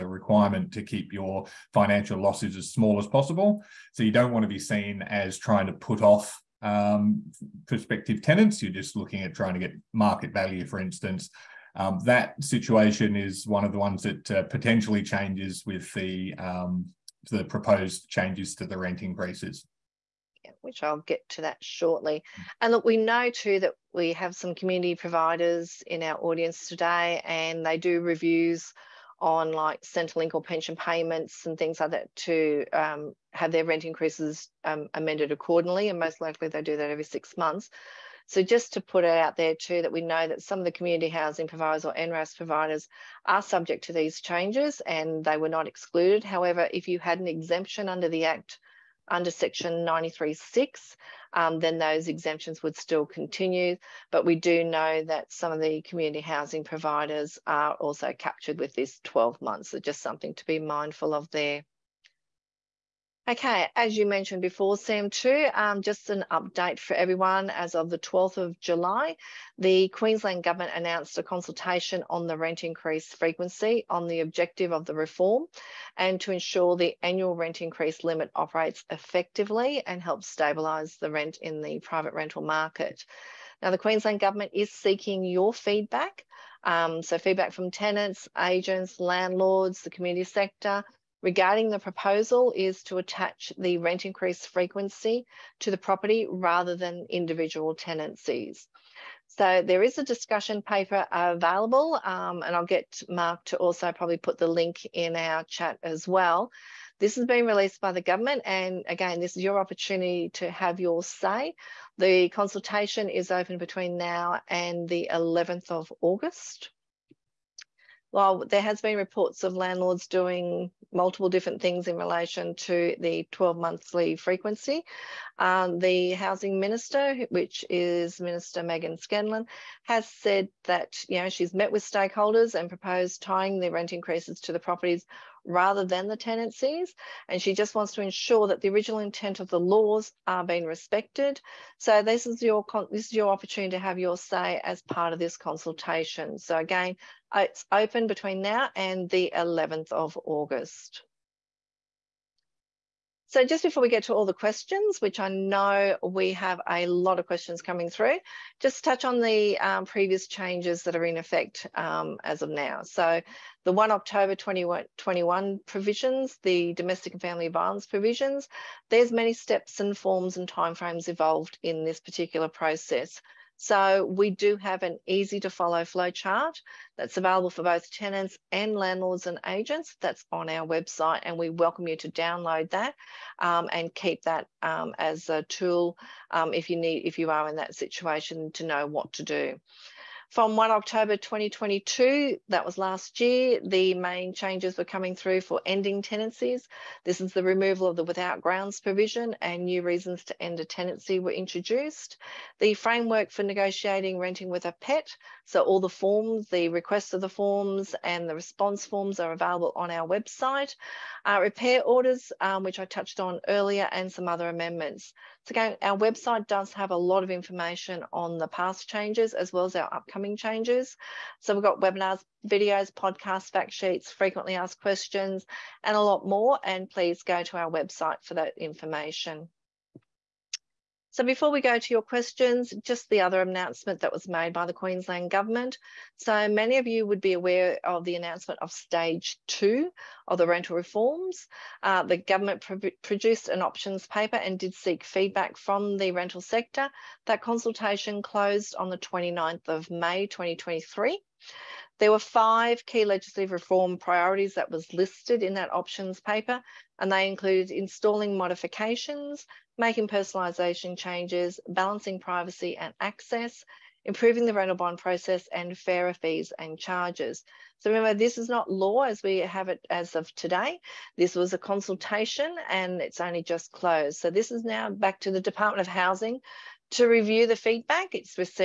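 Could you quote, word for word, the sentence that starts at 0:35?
And most likely they do that every six months.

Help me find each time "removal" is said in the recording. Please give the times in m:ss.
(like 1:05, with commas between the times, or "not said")
3:17.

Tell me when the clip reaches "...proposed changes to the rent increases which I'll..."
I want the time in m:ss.
0:17.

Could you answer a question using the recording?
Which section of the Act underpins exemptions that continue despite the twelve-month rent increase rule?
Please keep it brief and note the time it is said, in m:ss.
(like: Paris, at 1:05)
93.6, at 0:49.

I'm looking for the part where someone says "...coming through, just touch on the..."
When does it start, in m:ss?
2:37.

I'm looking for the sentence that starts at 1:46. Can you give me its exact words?
This has been released by the government and again, this is your opportunity to have your say.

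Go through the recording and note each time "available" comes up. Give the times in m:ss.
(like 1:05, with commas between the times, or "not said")
1:41, 2:57, 3:29.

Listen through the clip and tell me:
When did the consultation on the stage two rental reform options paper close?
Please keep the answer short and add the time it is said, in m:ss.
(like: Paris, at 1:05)
29 May 2023, at 4:08.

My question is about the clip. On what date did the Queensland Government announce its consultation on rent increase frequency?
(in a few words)
12 July.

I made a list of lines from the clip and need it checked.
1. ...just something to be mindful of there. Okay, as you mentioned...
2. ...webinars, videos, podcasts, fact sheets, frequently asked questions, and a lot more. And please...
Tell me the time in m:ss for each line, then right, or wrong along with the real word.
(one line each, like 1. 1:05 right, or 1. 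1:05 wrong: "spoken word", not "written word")
1. 0:59 right
2. 3:41 right.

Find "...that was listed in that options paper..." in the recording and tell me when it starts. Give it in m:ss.
4:14.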